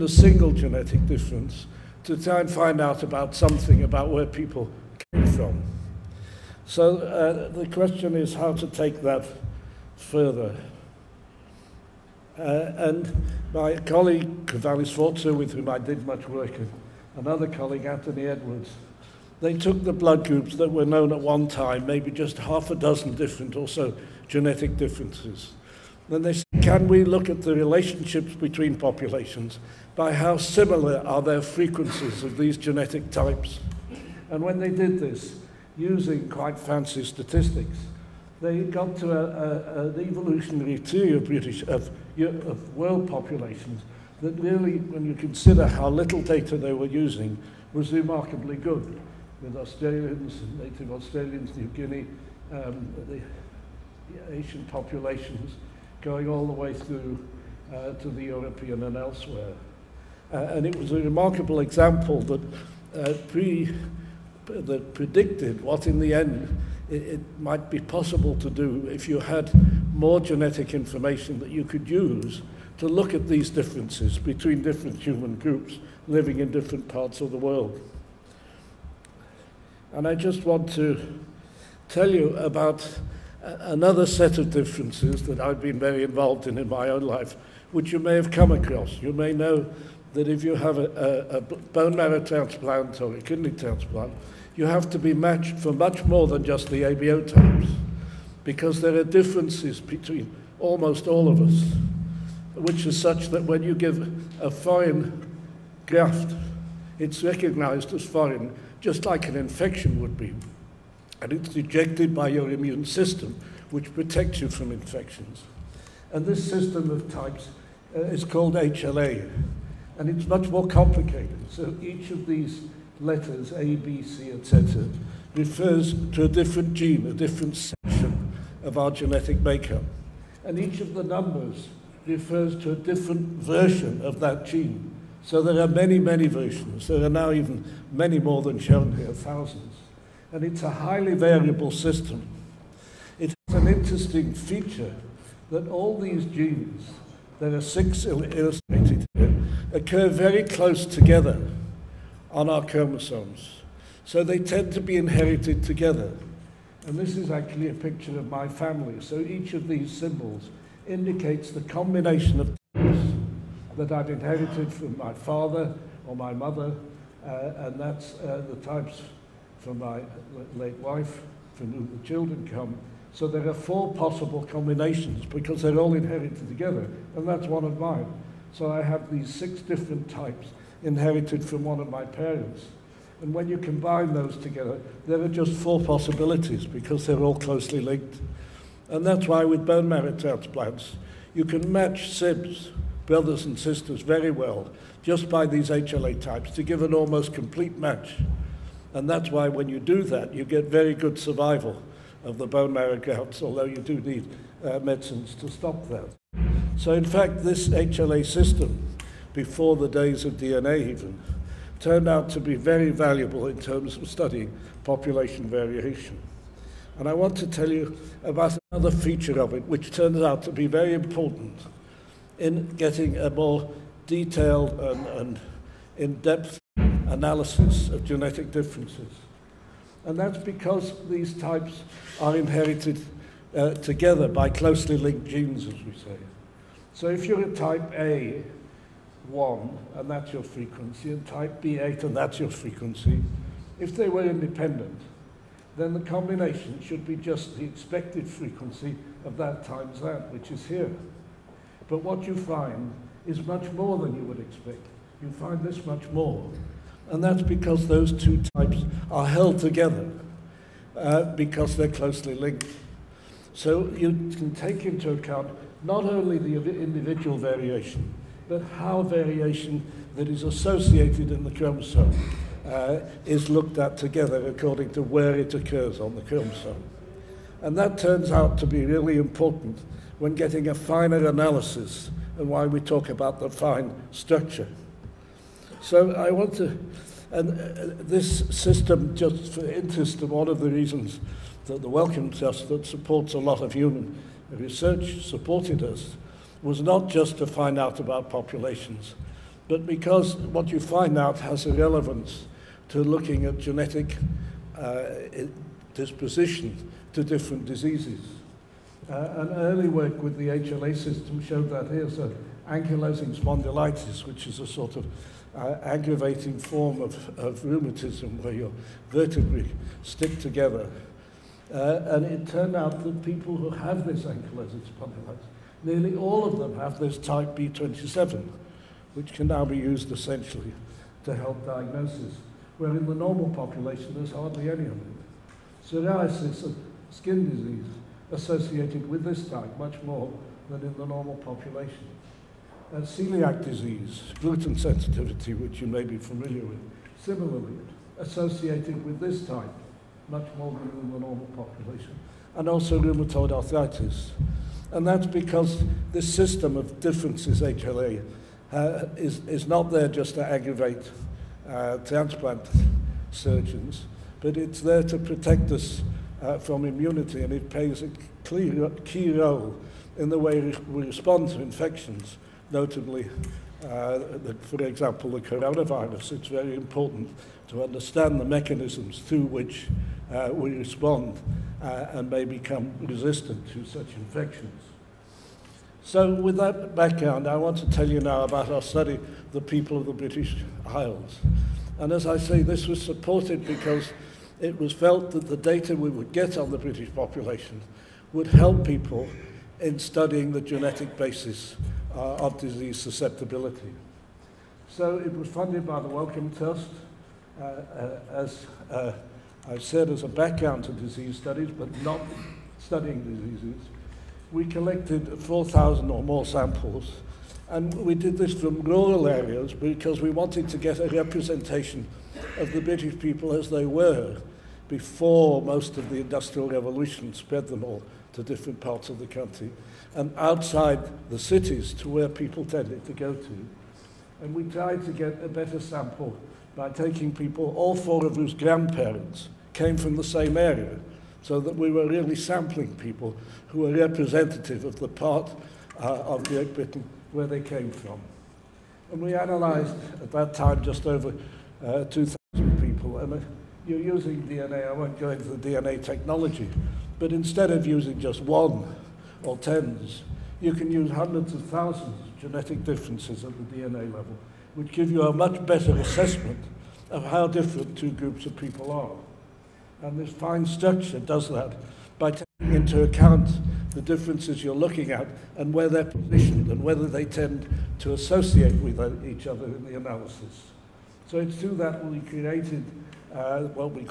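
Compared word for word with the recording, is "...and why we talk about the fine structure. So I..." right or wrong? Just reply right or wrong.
right.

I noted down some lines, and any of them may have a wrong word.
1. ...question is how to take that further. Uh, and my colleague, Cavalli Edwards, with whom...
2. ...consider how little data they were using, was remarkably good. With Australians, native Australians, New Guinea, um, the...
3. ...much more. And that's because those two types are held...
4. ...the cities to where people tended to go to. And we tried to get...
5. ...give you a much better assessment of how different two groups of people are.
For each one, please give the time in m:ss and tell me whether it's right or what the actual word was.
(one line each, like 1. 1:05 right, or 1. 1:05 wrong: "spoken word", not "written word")
1. 0:07 wrong: "Sforza", not "Edwards"
2. 0:45 right
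3. 4:15 right
4. 7:11 right
5. 7:44 right.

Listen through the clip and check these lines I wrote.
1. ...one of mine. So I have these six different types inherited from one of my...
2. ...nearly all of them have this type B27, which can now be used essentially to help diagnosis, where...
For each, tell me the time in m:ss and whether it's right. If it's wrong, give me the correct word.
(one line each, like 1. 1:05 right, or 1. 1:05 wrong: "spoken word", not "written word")
1. 2:57 right
2. 5:25 right.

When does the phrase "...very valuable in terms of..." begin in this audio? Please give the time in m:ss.
3:32.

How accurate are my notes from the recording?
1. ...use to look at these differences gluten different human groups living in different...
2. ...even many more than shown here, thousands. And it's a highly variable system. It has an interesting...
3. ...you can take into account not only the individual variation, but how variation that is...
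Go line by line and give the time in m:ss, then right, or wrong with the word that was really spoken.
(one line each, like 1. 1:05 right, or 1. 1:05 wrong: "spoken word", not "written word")
1. 1:11 wrong: "between", not "gluten"
2. 2:17 right
3. 4:23 right.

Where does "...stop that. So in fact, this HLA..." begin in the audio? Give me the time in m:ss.
3:25.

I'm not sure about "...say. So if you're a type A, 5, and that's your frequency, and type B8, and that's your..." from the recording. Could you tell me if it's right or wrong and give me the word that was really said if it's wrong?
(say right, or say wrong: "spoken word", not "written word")
wrong: "1", not "5".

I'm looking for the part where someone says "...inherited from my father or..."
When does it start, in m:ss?
2:44.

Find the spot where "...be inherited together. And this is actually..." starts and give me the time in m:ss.
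2:34.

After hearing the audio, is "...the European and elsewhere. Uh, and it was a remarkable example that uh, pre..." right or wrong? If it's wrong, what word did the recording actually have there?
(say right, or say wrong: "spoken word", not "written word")
right.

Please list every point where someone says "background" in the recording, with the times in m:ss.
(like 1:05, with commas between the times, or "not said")
6:26, 6:50.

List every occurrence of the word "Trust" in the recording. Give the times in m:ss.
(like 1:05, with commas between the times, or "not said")
4:52, 6:46.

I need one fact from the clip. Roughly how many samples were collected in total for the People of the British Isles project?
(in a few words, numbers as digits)
4,000.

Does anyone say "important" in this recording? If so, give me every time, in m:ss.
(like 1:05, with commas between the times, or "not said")
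3:40, 4:39, 6:16.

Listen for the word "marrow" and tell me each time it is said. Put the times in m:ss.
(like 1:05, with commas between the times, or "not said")
1:31, 3:09, 3:22.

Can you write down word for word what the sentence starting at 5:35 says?
Psoriasis and skin disease associated with this type much more than in the normal population.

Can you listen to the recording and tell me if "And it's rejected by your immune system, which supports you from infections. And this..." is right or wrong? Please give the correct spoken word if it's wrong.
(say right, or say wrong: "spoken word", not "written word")
wrong: "protects", not "supports".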